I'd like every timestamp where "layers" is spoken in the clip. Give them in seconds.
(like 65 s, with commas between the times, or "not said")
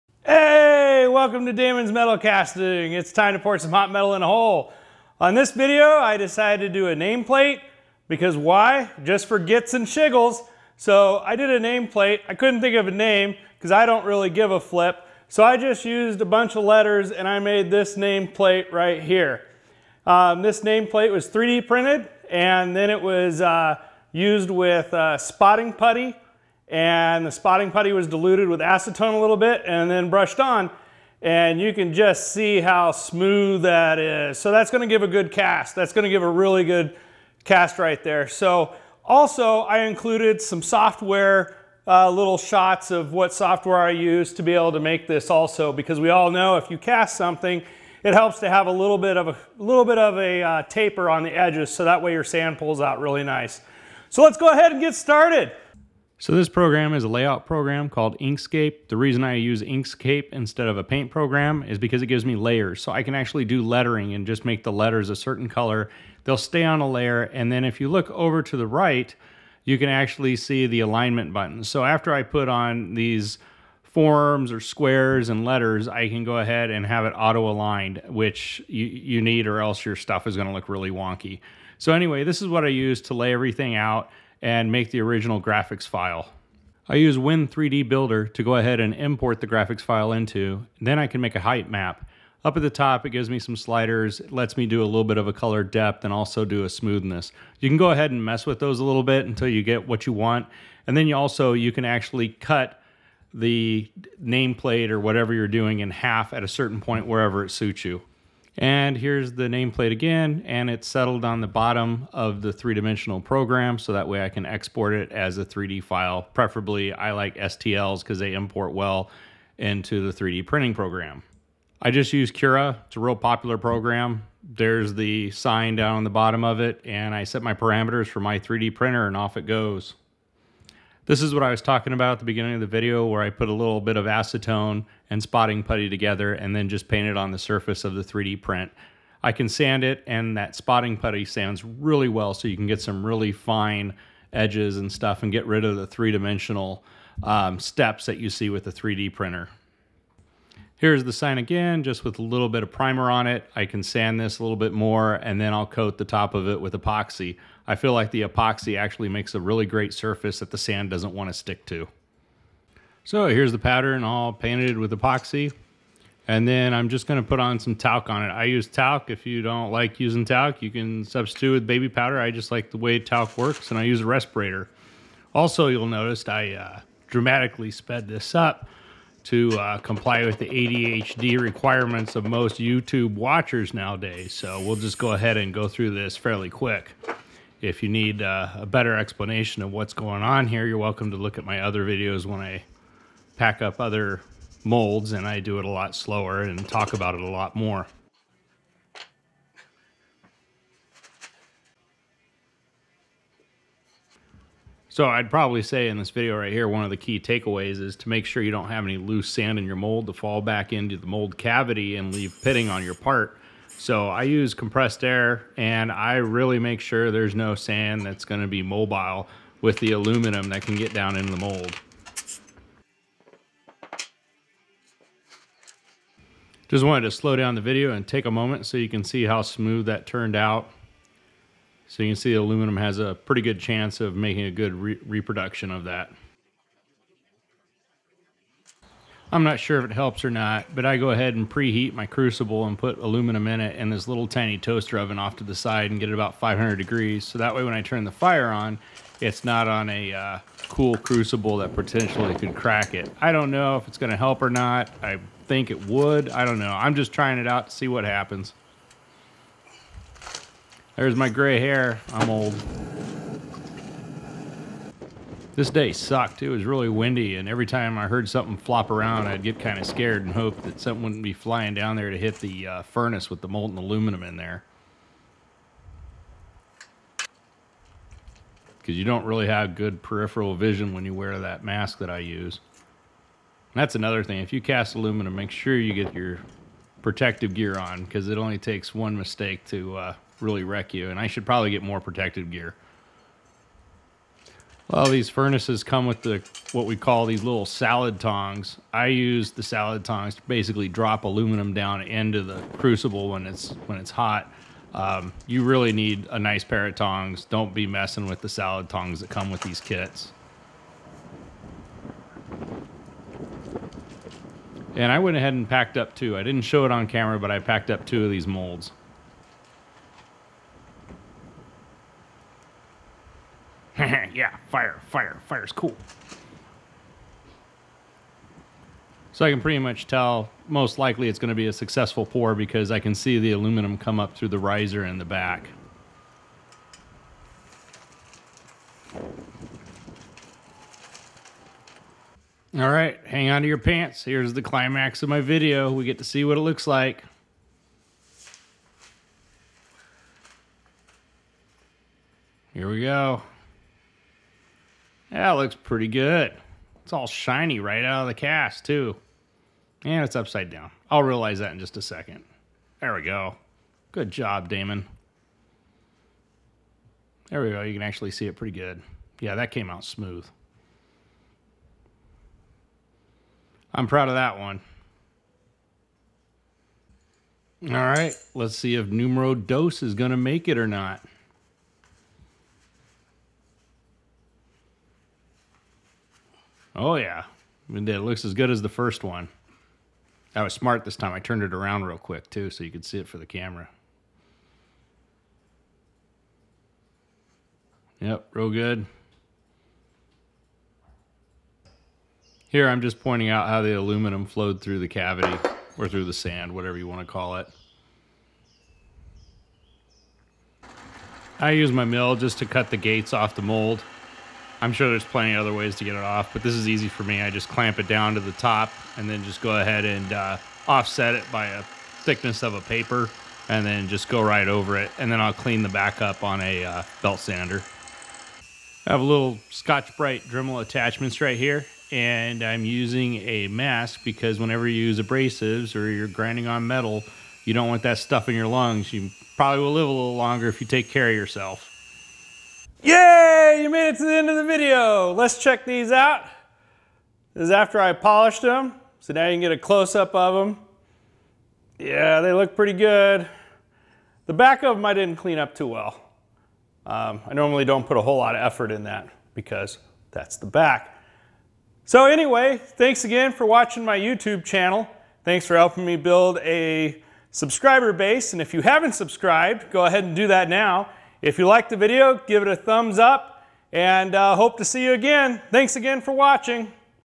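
62 s, 66 s.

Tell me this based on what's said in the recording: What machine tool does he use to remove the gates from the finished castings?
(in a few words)
Mill.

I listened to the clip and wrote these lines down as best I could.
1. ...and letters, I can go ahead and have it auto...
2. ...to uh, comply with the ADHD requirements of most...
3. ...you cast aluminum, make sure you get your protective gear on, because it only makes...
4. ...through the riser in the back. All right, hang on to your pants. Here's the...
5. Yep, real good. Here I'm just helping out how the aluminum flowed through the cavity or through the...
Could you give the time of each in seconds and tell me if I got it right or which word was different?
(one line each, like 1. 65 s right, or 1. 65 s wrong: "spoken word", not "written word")
1. 75 s right
2. 179 s right
3. 284 s wrong: "takes", not "makes"
4. 334 s right
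5. 398 s wrong: "pointing", not "helping".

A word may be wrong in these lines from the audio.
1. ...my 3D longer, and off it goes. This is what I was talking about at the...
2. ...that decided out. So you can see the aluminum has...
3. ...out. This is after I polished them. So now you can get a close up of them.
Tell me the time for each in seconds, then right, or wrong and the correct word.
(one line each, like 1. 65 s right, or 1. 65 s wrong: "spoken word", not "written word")
1. 128 s wrong: "printer", not "longer"
2. 229 s wrong: "turned", not "decided"
3. 446 s right.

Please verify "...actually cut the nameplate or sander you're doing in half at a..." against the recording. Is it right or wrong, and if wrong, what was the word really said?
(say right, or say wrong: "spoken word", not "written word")
wrong: "whatever", not "sander".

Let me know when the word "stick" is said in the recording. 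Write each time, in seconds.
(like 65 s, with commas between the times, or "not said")
161 s.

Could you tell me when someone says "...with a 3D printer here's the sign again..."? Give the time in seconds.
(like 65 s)
148 s.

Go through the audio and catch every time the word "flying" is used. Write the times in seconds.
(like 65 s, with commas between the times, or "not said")
271 s.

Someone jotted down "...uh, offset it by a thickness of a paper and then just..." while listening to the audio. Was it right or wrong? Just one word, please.
right.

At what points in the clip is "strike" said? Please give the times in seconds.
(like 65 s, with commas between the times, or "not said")
not said.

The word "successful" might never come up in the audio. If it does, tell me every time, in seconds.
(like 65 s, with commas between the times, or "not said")
331 s.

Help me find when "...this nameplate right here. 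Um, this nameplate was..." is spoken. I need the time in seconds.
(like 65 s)
17 s.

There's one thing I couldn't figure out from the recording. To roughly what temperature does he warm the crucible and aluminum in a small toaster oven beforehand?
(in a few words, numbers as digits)
500 degrees.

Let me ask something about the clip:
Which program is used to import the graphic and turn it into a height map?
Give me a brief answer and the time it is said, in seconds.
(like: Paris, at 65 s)
Win3D Builder, at 87 s.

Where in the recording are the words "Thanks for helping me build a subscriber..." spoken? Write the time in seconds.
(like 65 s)
465 s.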